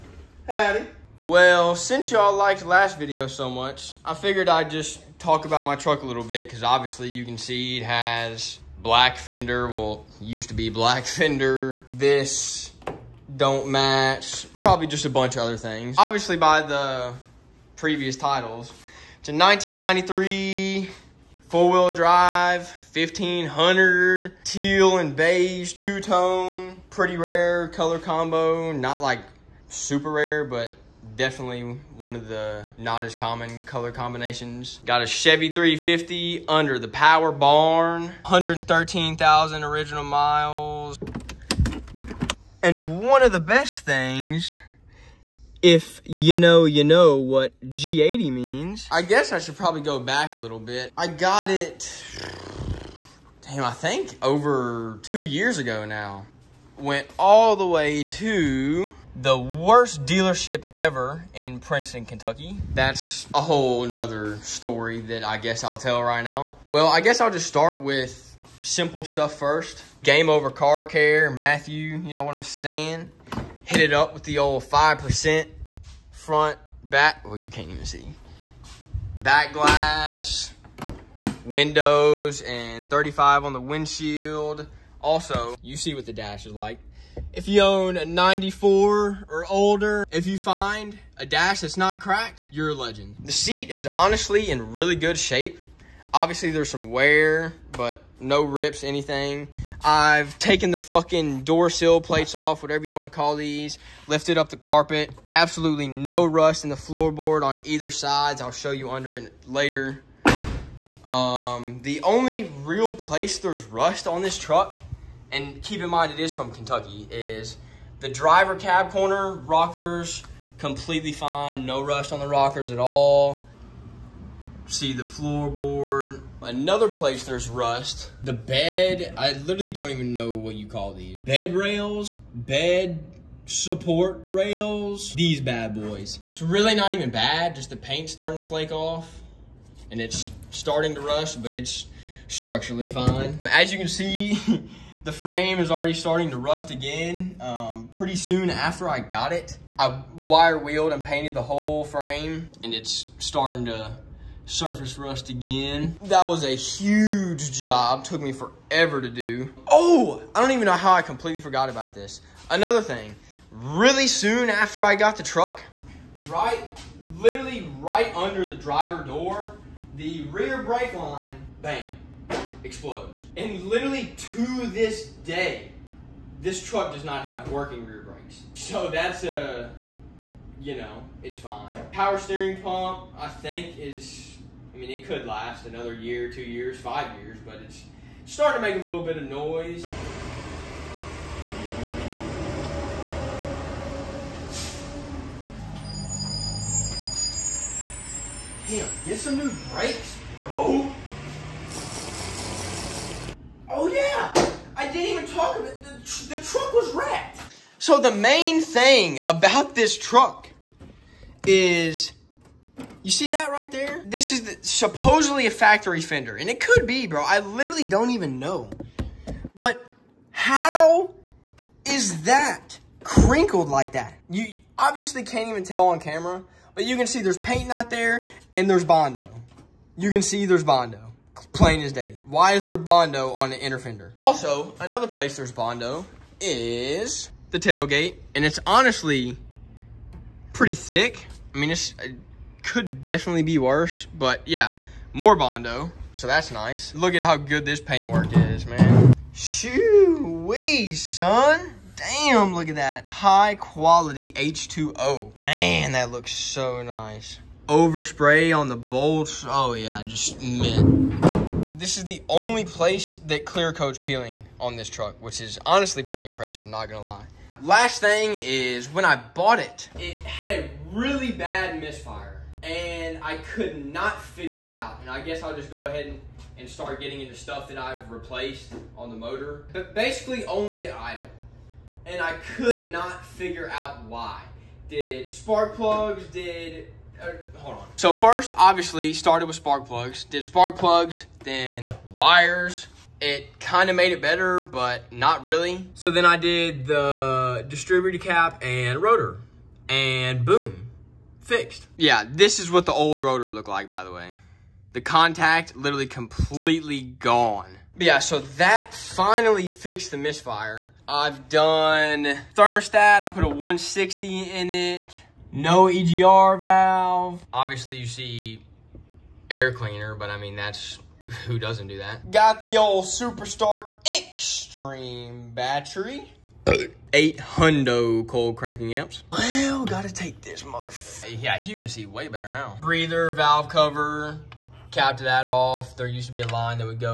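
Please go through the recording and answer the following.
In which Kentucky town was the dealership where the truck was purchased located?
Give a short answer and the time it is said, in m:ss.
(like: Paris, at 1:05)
Princeton, at 1:01.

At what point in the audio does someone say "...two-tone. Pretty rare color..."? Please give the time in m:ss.
0:25.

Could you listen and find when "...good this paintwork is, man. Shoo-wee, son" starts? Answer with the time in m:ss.
4:07.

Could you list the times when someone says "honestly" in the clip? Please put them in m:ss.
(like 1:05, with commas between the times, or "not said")
1:33, 3:58, 4:25.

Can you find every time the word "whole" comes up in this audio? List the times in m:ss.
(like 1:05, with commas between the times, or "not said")
1:03, 2:31.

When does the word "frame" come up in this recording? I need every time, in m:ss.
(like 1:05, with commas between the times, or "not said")
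2:25, 2:31.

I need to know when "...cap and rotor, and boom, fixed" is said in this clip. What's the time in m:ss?
4:58.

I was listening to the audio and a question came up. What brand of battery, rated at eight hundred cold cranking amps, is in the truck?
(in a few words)
Super Start Extreme.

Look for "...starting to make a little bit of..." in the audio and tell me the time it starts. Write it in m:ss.
3:08.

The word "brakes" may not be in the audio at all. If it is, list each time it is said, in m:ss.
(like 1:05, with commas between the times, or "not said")
2:50, 2:58, 3:19.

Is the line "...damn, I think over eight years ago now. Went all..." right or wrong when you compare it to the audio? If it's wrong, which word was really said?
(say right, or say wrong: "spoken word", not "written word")
wrong: "two", not "eight".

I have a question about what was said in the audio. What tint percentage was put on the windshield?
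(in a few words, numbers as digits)
35.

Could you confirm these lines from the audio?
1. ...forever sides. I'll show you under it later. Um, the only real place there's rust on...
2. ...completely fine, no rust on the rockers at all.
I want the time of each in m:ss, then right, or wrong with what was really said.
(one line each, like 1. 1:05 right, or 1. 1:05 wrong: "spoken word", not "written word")
1. 1:47 wrong: "either", not "forever"
2. 2:00 right.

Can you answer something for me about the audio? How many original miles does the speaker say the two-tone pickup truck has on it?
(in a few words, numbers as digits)
113,000.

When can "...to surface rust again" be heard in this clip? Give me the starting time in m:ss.
2:33.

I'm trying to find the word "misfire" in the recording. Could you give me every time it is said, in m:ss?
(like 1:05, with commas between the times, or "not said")
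4:31, 5:10.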